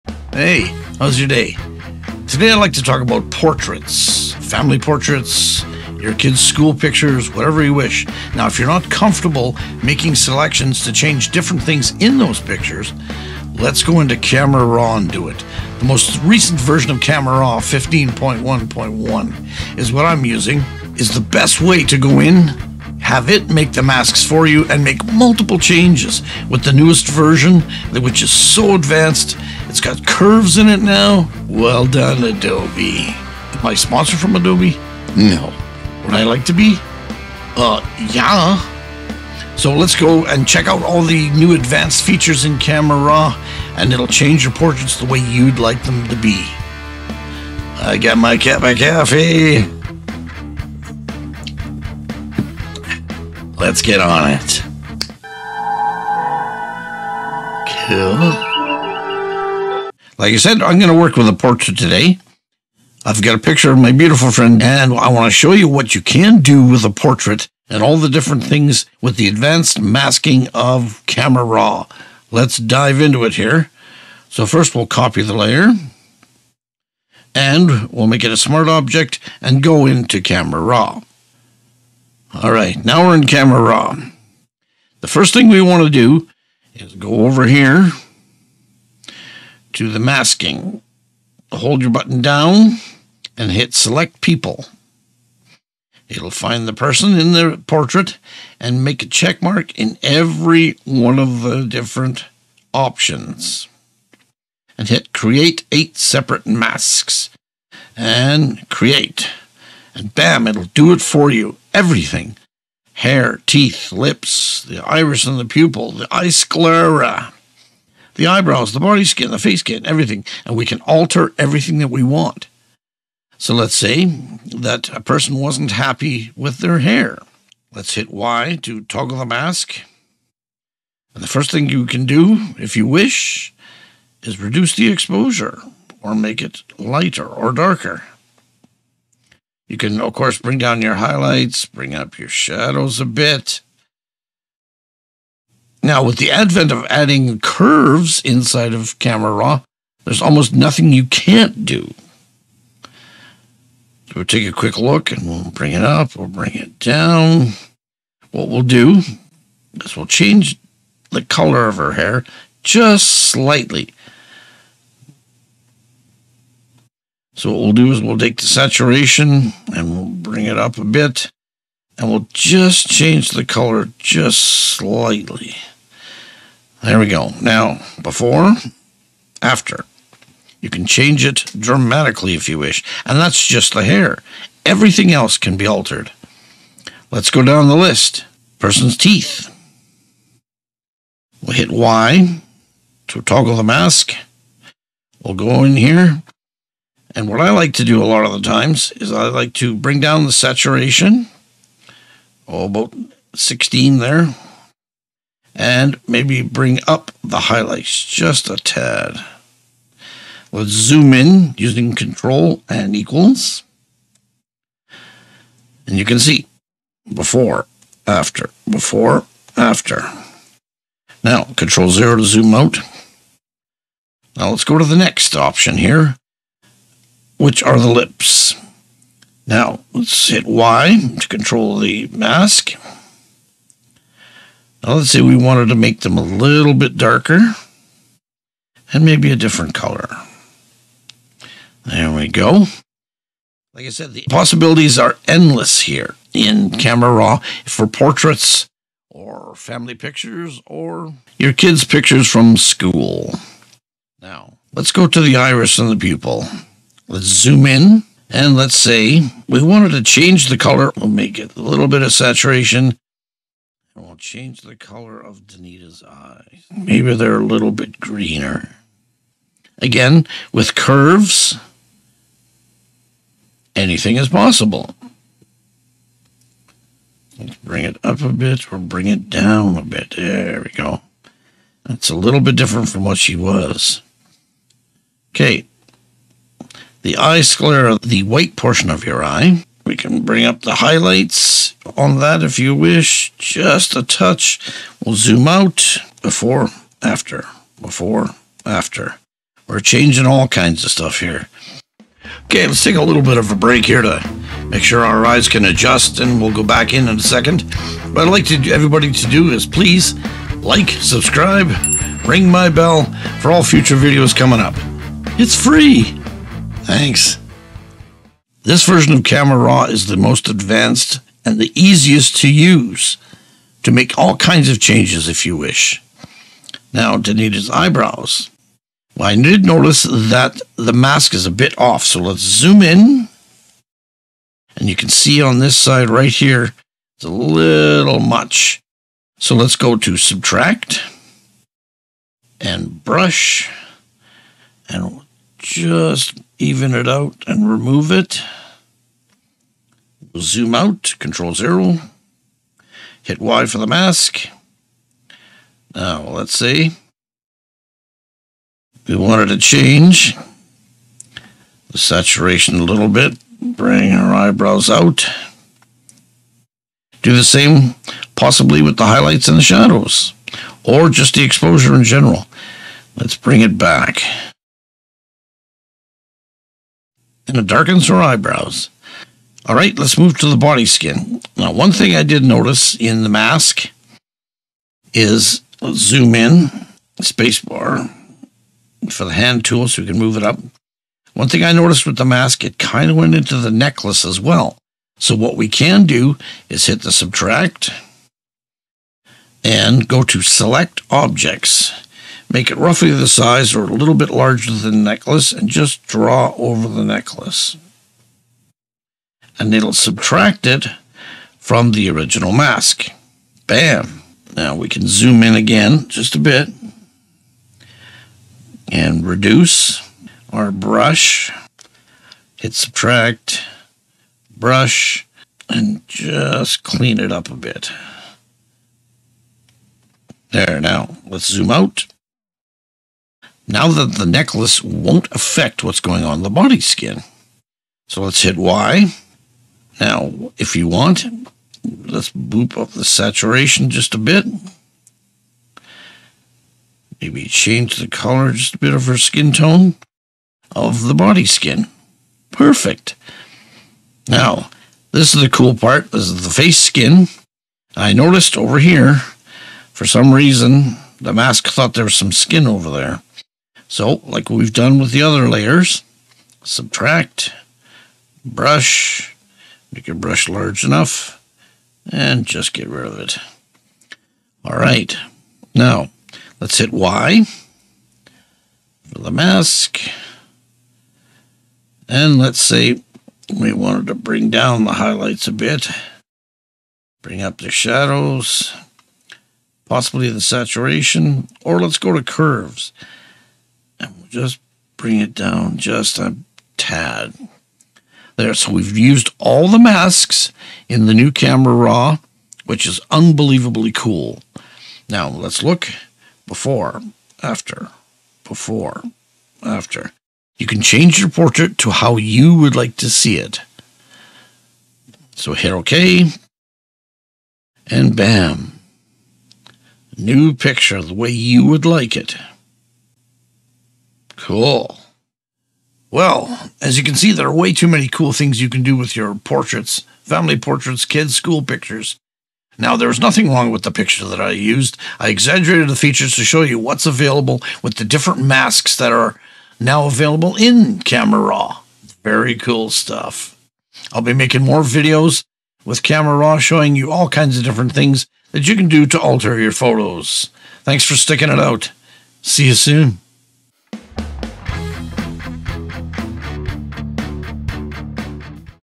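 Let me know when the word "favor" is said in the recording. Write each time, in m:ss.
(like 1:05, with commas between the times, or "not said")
not said.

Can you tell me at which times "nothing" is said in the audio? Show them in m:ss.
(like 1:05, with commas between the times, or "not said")
2:30, 8:53.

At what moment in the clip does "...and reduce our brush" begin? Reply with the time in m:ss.
6:58.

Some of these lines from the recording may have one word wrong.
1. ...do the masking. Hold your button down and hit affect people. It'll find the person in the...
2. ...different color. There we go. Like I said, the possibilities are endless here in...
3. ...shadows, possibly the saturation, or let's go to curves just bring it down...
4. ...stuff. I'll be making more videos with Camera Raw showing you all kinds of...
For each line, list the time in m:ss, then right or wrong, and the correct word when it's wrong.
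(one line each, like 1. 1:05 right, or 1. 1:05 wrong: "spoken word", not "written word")
1. 1:29 wrong: "select", not "affect"
2. 3:59 right
3. 8:07 right
4. 9:02 right.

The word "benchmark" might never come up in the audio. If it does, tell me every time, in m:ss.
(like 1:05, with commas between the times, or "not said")
not said.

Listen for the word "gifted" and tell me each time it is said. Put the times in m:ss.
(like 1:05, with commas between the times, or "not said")
not said.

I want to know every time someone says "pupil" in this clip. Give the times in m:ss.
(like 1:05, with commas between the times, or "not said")
1:55, 4:15.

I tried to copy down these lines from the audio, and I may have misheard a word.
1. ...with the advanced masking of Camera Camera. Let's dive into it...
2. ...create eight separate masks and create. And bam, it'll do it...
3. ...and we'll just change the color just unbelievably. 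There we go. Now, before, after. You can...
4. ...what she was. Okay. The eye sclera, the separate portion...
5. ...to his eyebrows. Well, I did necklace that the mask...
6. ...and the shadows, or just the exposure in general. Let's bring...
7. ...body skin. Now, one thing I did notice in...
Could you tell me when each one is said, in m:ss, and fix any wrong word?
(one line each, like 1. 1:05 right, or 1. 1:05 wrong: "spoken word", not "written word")
1. 1:09 wrong: "Raw", not "Camera"
2. 1:45 right
3. 2:51 wrong: "slightly", not "unbelievably"
4. 4:43 wrong: "white", not "separate"
5. 5:27 wrong: "notice", not "necklace"
6. 6:09 right
7. 6:20 right.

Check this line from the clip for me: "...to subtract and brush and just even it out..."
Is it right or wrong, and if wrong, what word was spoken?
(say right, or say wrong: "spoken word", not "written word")
right.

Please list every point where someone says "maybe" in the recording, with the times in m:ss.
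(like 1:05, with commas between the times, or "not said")
3:26, 3:59, 4:26, 7:27.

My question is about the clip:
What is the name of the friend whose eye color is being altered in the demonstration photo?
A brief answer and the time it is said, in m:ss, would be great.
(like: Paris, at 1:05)
Danita, at 4:25.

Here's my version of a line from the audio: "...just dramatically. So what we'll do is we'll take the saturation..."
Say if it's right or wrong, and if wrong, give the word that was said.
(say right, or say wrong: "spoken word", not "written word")
wrong: "slightly", not "dramatically".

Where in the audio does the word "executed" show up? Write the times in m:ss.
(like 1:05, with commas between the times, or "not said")
not said.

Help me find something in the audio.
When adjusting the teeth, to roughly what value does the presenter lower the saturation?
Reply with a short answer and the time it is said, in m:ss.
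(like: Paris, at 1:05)
16, at 3:23.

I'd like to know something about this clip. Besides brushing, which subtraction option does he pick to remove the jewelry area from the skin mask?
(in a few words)
Select objects.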